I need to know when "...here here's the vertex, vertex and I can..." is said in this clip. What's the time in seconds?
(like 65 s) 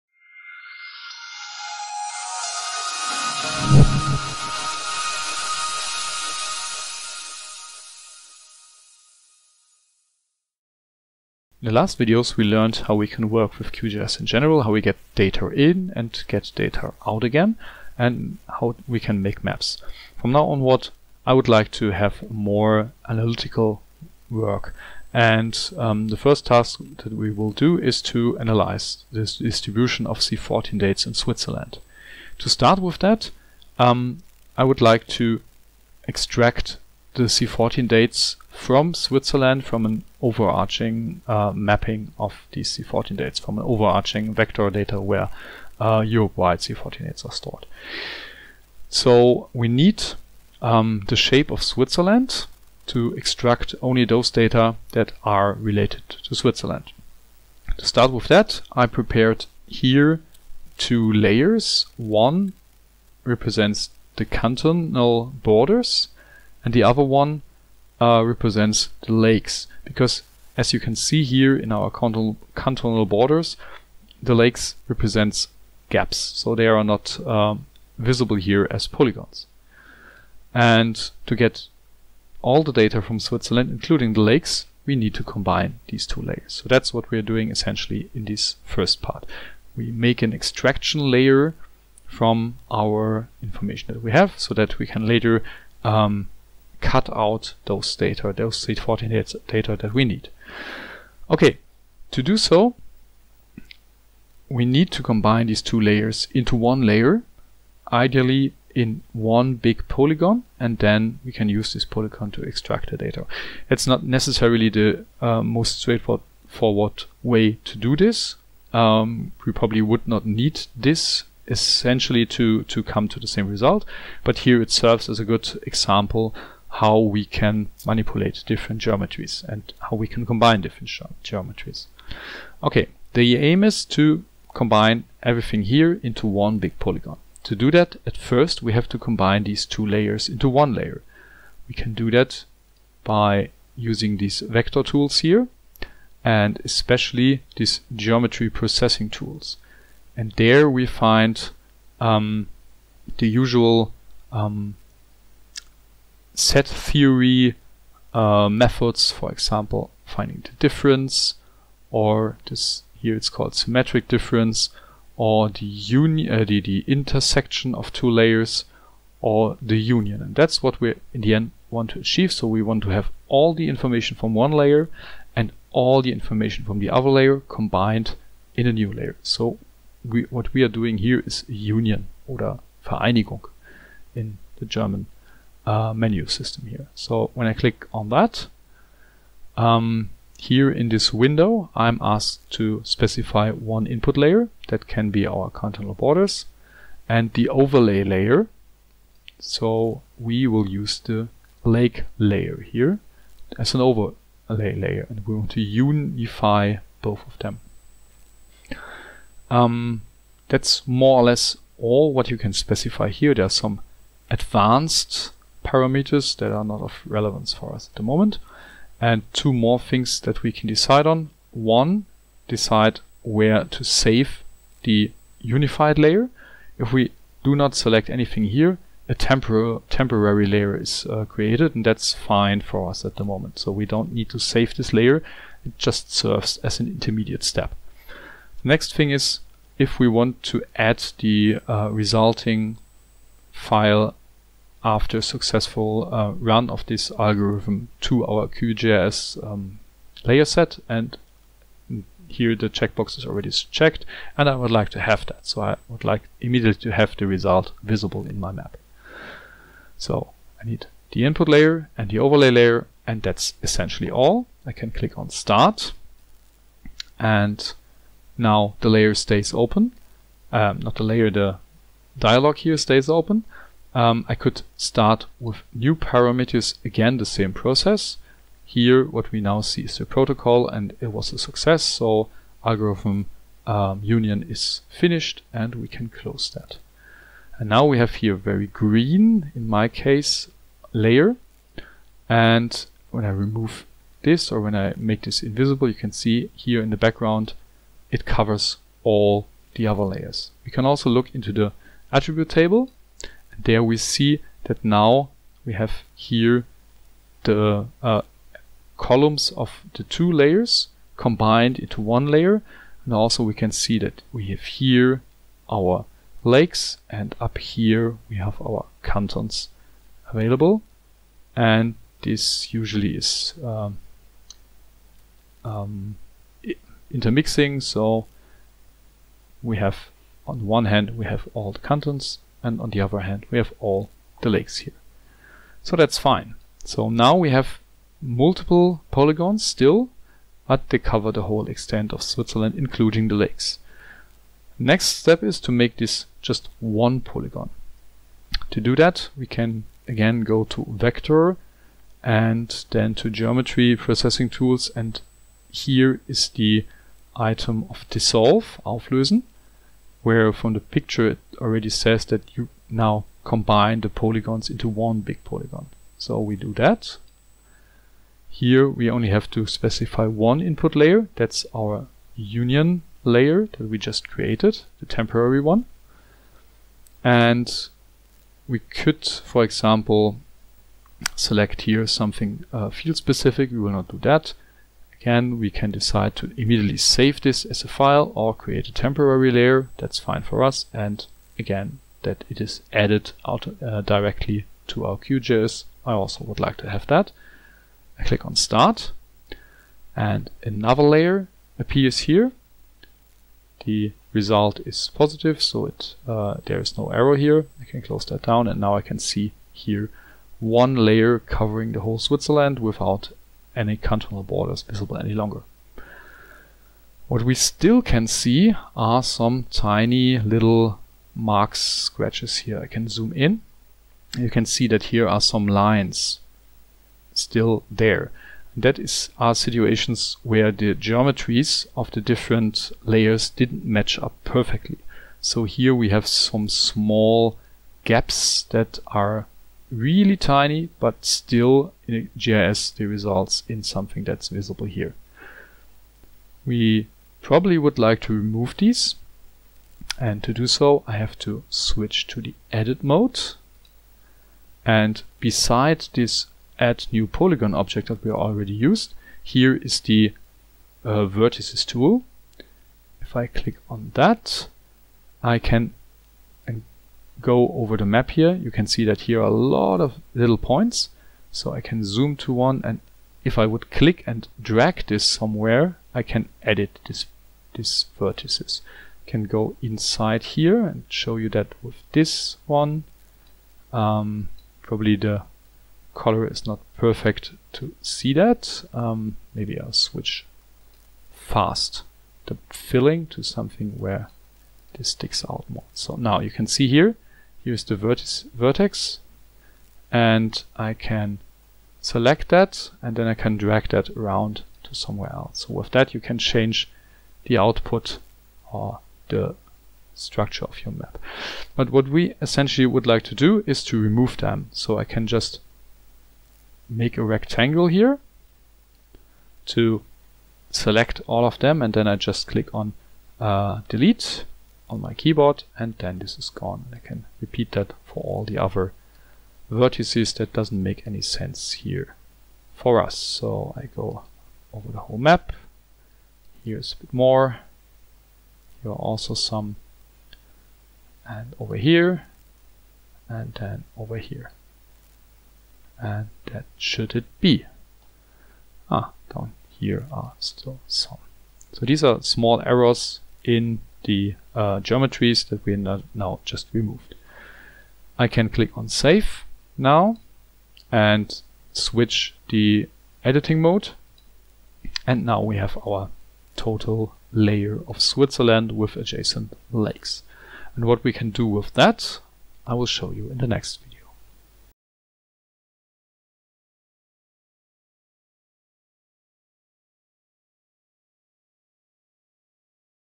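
496 s.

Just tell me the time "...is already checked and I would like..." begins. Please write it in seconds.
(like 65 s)
253 s.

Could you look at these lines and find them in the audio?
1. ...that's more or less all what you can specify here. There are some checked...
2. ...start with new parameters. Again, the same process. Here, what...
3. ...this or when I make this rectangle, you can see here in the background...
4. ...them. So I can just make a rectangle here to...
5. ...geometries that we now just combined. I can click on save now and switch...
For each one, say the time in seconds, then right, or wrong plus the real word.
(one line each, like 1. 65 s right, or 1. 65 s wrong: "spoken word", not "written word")
1. 210 s wrong: "advanced", not "checked"
2. 274 s right
3. 294 s wrong: "invisible", not "rectangle"
4. 514 s right
5. 554 s wrong: "removed", not "combined".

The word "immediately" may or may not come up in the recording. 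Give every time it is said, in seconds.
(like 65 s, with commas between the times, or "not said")
256 s, 386 s.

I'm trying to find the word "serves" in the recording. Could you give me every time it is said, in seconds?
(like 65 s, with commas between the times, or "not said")
124 s, 236 s.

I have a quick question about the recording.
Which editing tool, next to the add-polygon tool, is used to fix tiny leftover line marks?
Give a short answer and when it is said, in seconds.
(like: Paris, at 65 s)
Vertices tool, at 461 s.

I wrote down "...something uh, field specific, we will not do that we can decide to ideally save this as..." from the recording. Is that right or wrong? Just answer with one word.
wrong.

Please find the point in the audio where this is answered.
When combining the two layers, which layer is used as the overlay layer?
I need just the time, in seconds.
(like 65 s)
201 s.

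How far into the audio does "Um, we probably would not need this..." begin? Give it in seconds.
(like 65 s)
118 s.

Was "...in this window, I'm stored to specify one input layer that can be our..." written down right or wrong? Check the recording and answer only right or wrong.
wrong.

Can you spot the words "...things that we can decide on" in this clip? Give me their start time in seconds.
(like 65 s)
219 s.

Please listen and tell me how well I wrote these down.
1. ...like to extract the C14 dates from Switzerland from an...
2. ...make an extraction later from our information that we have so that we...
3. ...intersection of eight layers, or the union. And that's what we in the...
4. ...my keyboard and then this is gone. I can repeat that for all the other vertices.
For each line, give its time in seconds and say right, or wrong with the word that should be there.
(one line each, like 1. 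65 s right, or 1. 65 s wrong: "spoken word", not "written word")
1. 34 s right
2. 89 s wrong: "layer", not "later"
3. 166 s wrong: "two", not "eight"
4. 524 s right.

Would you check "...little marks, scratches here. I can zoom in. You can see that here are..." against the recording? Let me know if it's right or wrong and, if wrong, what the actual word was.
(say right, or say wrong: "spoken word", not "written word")
right.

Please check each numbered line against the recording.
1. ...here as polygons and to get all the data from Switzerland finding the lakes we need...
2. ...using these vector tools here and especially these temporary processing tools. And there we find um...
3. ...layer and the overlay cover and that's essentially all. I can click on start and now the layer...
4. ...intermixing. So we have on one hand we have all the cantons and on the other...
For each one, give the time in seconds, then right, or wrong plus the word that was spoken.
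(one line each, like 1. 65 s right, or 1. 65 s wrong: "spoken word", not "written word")
1. 78 s wrong: "including", not "finding"
2. 143 s wrong: "geometry", not "temporary"
3. 261 s wrong: "layer", not "cover"
4. 327 s right.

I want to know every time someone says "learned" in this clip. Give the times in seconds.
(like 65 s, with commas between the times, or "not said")
12 s.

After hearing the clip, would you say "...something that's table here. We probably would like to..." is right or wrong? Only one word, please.
wrong.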